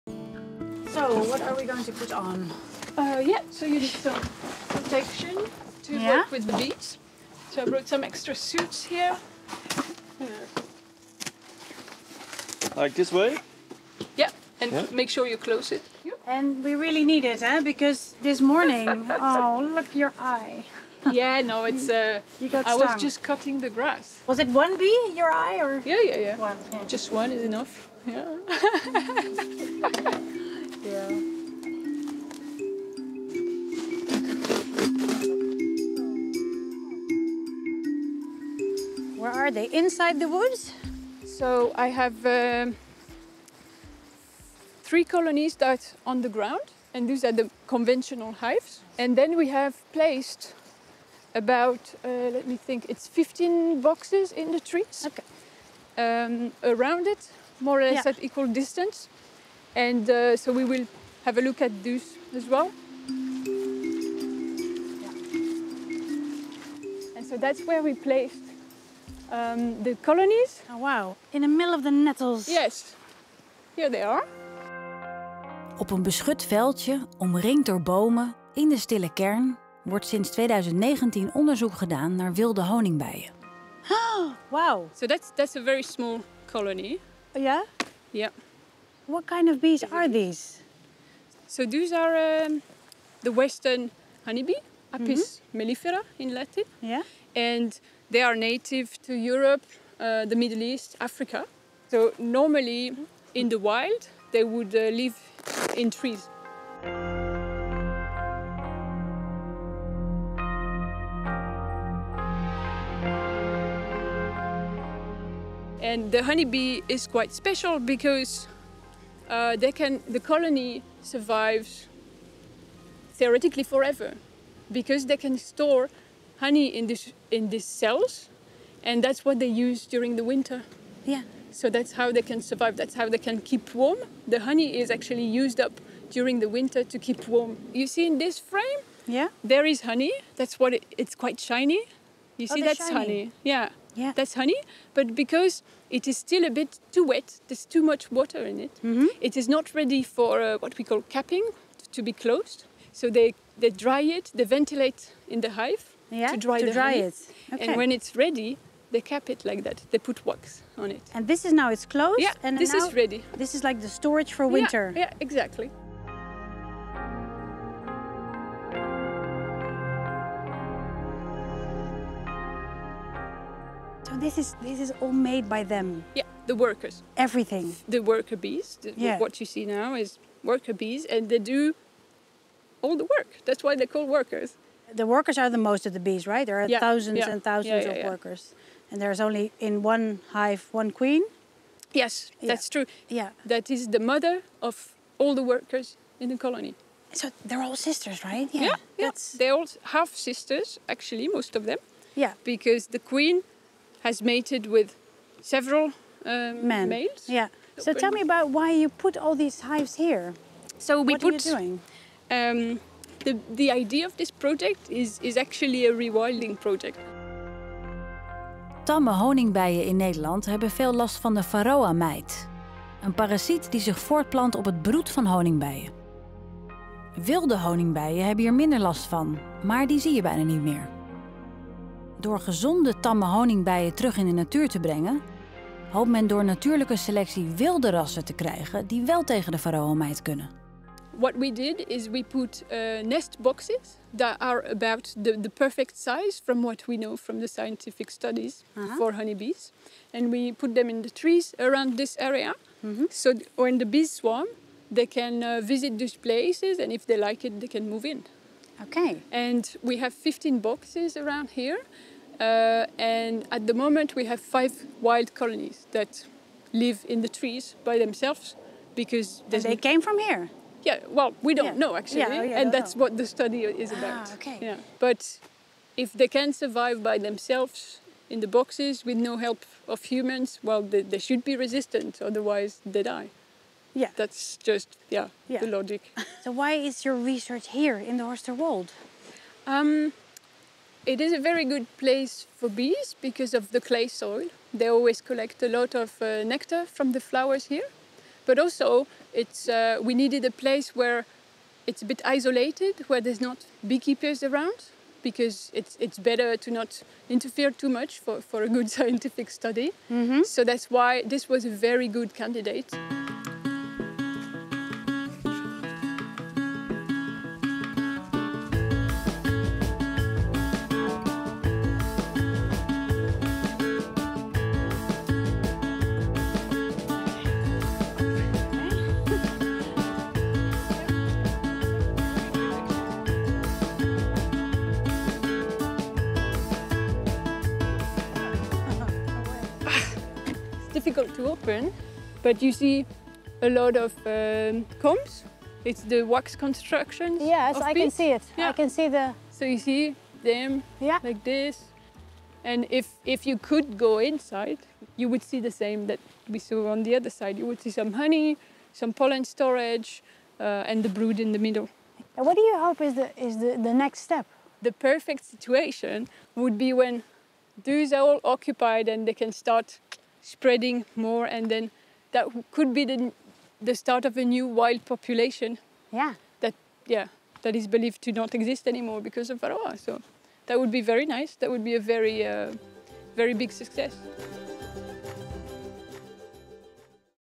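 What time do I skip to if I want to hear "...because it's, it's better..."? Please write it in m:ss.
5:05.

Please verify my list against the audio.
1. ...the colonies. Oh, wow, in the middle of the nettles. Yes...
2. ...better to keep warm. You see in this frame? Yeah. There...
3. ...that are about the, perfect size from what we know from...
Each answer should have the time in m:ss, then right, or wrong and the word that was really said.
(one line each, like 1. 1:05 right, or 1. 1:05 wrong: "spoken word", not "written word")
1. 1:09 right
2. 2:16 wrong: "winter", not "better"
3. 4:04 right.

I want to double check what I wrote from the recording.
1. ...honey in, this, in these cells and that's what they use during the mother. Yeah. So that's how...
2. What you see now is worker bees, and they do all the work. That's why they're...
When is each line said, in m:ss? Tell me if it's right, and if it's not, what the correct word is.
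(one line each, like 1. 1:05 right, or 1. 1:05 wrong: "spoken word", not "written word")
1. 2:06 wrong: "winter", not "mother"
2. 2:59 right.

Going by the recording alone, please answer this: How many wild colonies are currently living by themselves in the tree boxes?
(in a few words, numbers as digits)
5.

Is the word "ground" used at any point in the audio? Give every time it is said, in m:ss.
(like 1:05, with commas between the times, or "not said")
0:46.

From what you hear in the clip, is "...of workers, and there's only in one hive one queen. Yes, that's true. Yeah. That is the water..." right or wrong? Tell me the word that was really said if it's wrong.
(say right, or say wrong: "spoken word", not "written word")
wrong: "mother", not "water".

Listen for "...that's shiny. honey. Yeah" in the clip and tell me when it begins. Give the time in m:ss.
2:22.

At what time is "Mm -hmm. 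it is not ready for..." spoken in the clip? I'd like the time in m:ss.
2:28.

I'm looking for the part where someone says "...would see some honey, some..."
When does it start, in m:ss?
5:57.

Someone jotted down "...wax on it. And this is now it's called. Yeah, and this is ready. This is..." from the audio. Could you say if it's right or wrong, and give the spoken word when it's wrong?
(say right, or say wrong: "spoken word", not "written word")
wrong: "closed", not "called".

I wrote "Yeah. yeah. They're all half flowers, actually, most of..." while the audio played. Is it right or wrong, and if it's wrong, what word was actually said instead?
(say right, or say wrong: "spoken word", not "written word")
wrong: "sisters", not "flowers".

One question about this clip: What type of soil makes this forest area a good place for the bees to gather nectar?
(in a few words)
clay.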